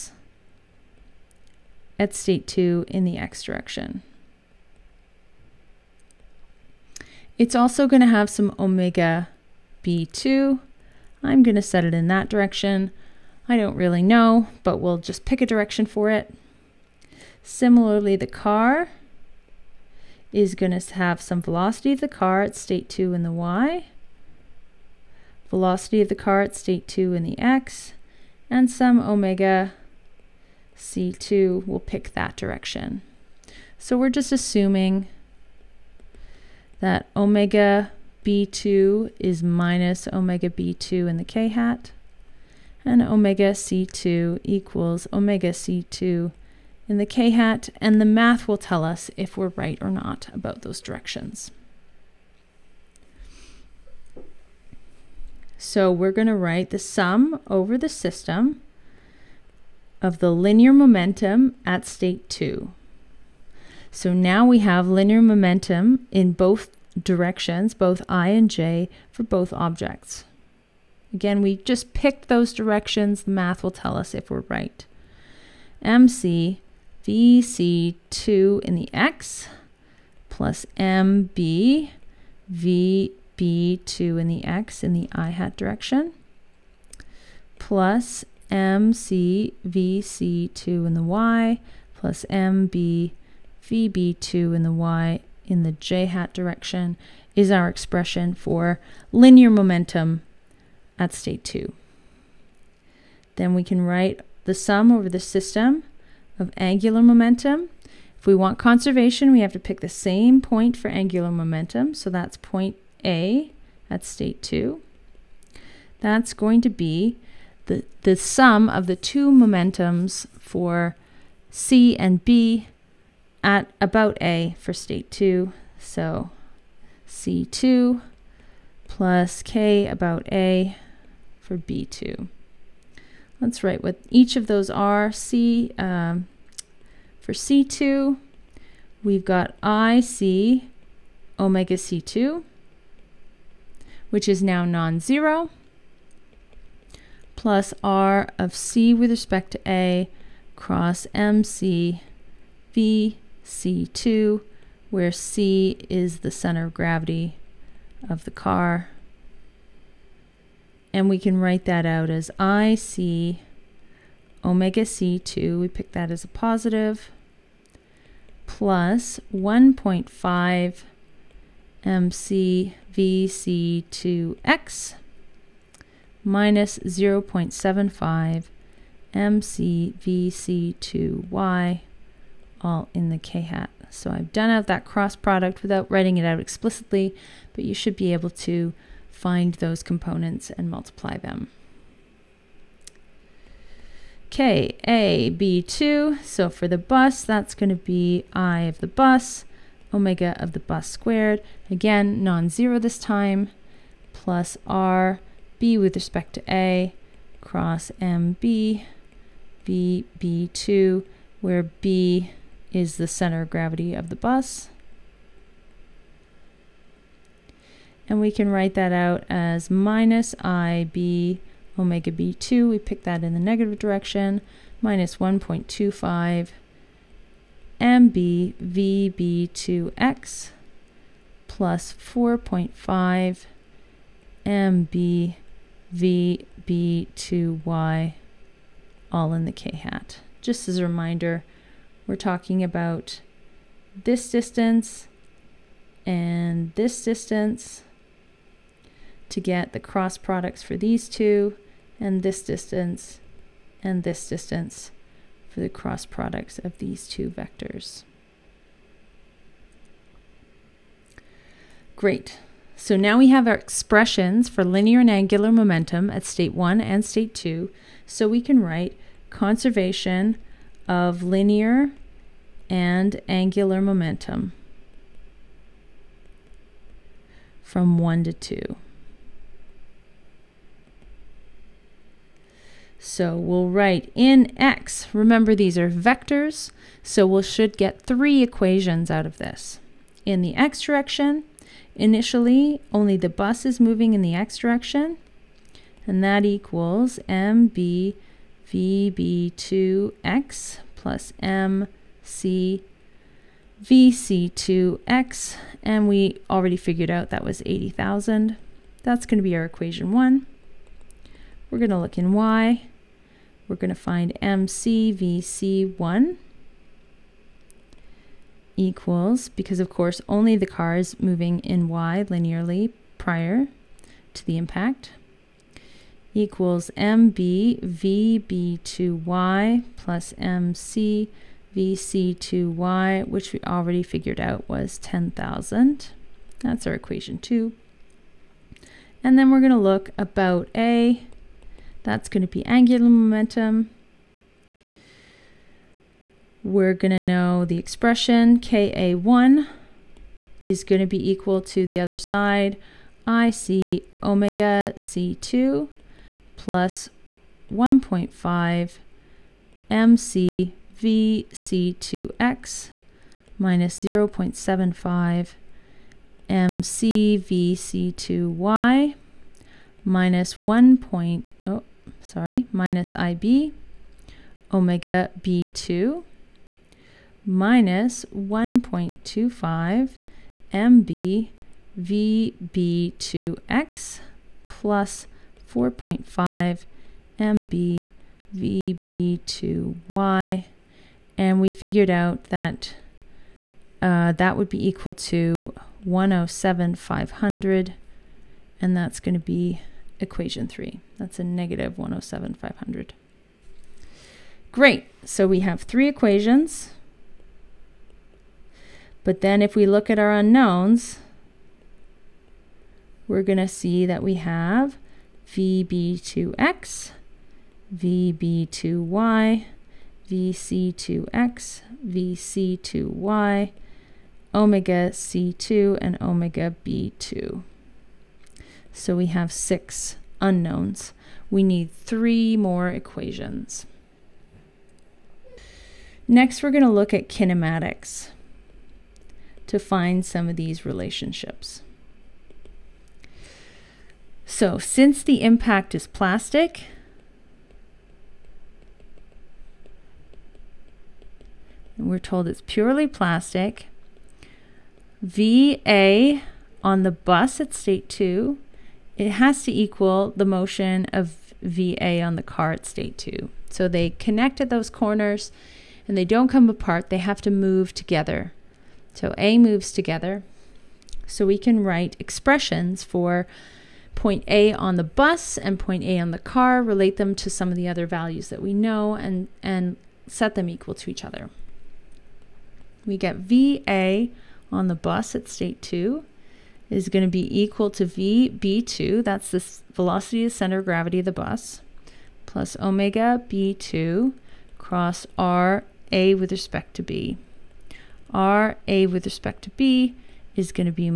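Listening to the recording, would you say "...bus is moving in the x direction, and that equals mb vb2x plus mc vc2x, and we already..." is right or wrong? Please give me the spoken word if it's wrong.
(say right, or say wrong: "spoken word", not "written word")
right.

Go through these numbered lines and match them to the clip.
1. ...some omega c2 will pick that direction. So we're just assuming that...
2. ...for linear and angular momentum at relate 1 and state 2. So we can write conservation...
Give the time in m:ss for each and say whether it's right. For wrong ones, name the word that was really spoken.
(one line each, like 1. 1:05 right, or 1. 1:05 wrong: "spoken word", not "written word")
1. 0:28 right
2. 4:24 wrong: "state", not "relate".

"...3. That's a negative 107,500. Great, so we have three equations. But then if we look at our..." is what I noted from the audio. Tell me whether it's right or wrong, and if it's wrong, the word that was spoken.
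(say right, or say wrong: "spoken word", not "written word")
right.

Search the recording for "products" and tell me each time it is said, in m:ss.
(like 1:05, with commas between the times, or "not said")
3:05, 4:10, 4:16.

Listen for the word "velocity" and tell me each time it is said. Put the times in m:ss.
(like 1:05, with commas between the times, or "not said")
0:21, 0:25, 8:09.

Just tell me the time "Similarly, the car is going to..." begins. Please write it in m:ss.
0:17.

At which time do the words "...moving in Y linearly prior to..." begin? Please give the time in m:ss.
5:21.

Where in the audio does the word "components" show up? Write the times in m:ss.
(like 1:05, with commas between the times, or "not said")
3:09.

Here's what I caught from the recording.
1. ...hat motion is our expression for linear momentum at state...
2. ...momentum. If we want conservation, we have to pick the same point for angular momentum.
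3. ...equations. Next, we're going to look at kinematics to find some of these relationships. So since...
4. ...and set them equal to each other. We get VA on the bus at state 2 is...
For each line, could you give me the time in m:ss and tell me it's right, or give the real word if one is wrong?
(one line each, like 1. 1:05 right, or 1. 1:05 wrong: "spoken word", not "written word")
1. 1:36 wrong: "direction", not "motion"
2. 1:47 right
3. 7:12 right
4. 7:59 right.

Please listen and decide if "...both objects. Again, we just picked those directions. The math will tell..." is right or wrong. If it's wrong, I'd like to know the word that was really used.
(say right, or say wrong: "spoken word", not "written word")
right.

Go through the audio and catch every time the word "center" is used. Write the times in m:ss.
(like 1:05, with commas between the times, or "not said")
2:36, 3:33, 8:10.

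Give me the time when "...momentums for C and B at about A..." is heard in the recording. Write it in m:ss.
1:59.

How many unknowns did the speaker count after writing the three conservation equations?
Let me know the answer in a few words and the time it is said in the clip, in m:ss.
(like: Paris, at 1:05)
6, at 7:09.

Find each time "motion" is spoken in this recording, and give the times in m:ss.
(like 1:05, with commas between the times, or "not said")
7:40.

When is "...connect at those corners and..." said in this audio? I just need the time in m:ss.
7:44.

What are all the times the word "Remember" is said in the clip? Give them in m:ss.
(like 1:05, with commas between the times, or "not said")
4:45.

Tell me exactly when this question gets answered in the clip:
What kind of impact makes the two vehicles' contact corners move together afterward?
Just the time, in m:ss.
7:32.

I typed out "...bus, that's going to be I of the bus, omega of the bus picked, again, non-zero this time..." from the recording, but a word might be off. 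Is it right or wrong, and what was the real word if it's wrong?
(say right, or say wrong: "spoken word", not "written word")
wrong: "squared", not "picked".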